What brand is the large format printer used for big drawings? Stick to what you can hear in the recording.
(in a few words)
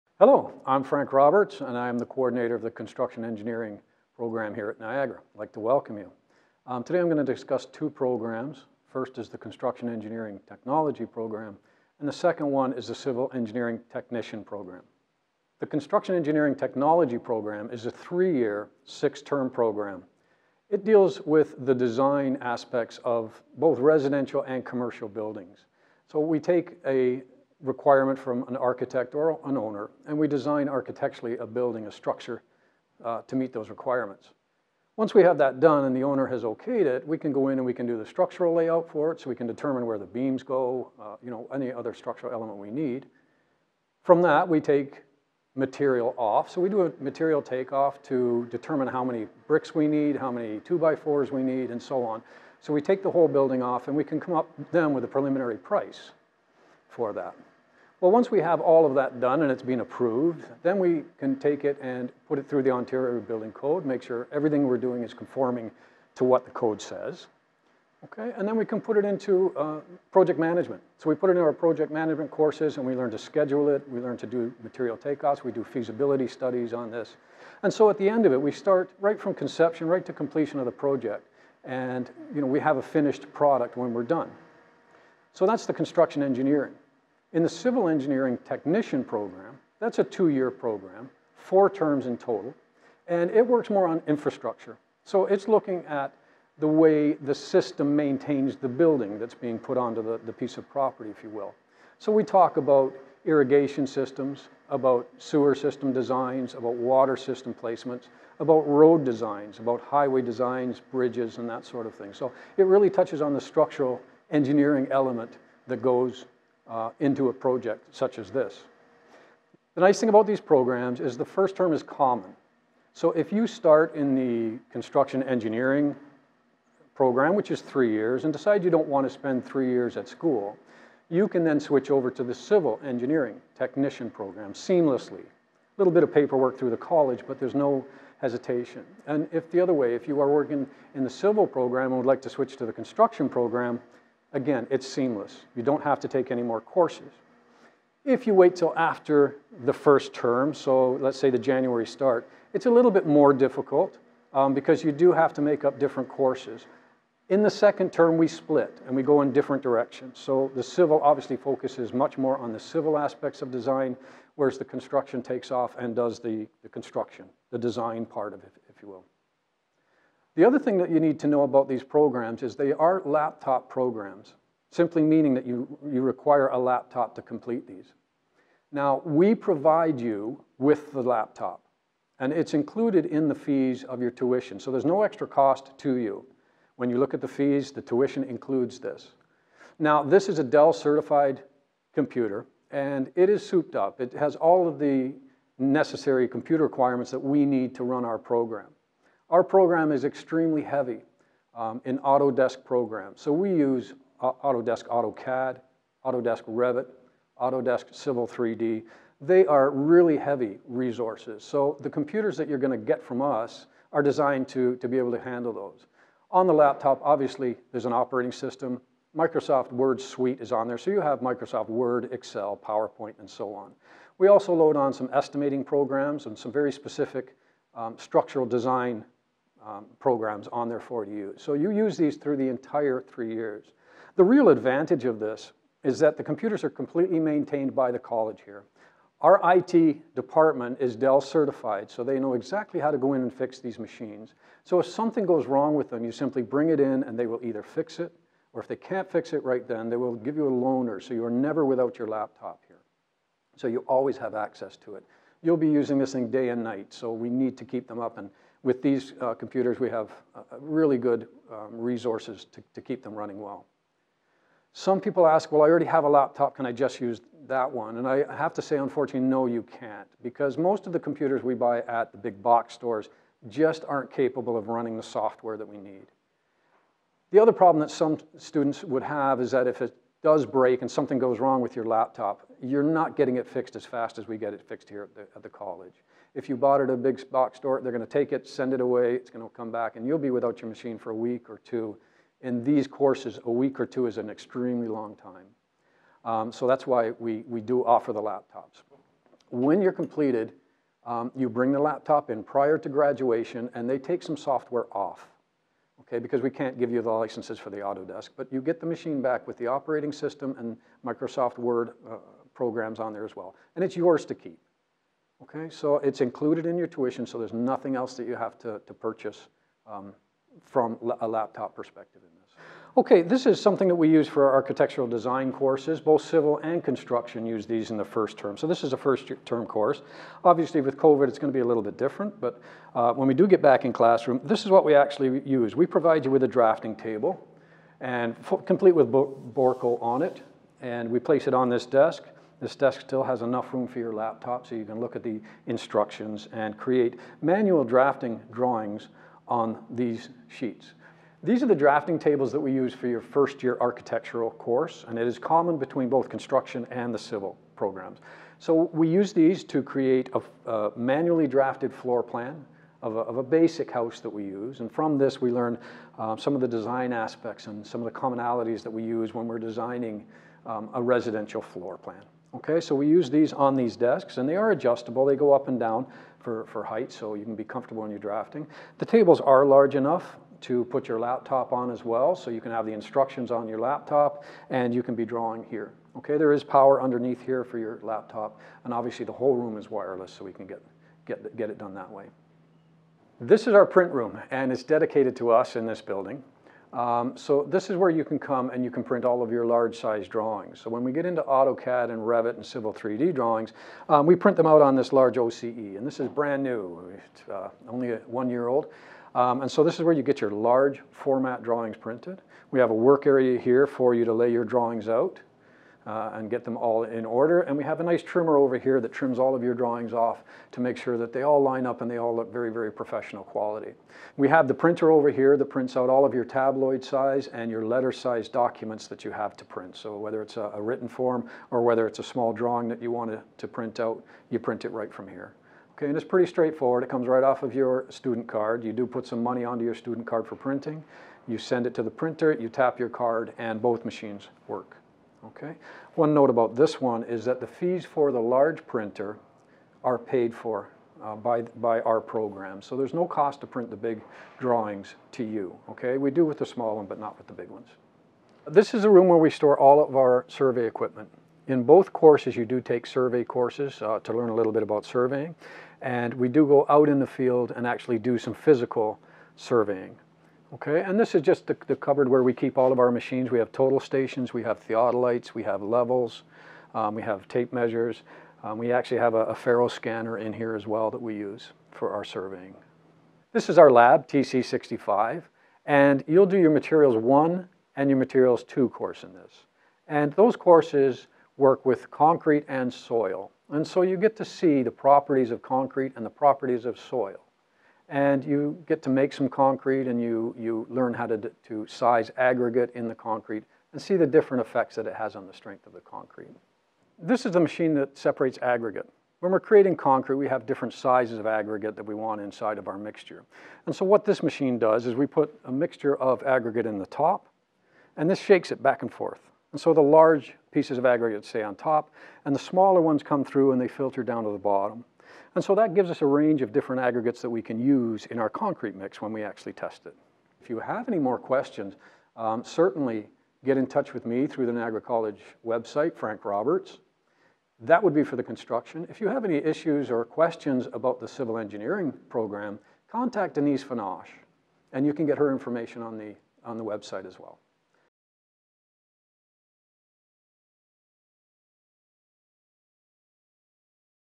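OCE.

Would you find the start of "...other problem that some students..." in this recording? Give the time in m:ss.
4:37.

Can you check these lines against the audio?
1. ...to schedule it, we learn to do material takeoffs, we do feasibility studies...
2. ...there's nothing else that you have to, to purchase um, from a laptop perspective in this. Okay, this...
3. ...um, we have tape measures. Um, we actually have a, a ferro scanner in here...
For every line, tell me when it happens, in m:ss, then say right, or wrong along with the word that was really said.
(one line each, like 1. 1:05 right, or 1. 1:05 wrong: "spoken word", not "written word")
1. 1:13 right
2. 5:17 right
3. 7:56 right.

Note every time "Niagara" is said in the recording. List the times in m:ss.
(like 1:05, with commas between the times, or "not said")
0:04, 8:54.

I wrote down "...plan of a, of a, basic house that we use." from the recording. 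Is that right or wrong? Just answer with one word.
right.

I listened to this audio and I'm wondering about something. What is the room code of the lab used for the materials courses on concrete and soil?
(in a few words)
TC65.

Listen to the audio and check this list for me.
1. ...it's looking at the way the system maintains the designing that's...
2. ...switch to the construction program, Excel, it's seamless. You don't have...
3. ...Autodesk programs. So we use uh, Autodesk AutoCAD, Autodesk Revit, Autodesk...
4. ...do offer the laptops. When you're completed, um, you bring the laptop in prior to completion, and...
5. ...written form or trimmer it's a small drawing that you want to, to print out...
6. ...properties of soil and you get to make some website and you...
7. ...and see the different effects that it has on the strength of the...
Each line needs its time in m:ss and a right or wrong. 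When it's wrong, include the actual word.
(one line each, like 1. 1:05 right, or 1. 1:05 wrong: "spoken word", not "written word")
1. 1:35 wrong: "building", not "designing"
2. 2:22 wrong: "Again", not "Excel"
3. 3:21 right
4. 4:57 wrong: "graduation", not "completion"
5. 7:10 wrong: "whether", not "trimmer"
6. 8:16 wrong: "concrete", not "website"
7. 8:23 right.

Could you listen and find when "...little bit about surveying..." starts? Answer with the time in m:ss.
7:44.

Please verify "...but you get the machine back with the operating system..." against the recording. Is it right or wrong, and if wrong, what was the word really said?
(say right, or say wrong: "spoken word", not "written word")
right.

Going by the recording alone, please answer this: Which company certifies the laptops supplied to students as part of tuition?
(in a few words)
Dell.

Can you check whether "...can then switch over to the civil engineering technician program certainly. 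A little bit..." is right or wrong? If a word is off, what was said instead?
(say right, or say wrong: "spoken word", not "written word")
wrong: "seamlessly", not "certainly".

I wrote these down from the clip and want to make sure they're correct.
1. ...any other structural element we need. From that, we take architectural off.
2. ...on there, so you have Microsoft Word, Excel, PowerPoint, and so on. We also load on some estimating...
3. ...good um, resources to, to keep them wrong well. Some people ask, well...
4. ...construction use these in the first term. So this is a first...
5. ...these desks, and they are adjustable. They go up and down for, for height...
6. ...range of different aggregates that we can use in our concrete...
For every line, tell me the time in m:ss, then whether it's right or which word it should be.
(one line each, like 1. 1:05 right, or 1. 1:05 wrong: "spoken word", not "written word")
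1. 0:41 wrong: "material", not "architectural"
2. 3:40 right
3. 4:20 wrong: "running", not "wrong"
4. 5:26 right
5. 6:13 right
6. 8:46 right.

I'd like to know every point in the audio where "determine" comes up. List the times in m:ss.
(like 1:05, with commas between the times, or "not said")
0:39, 0:48.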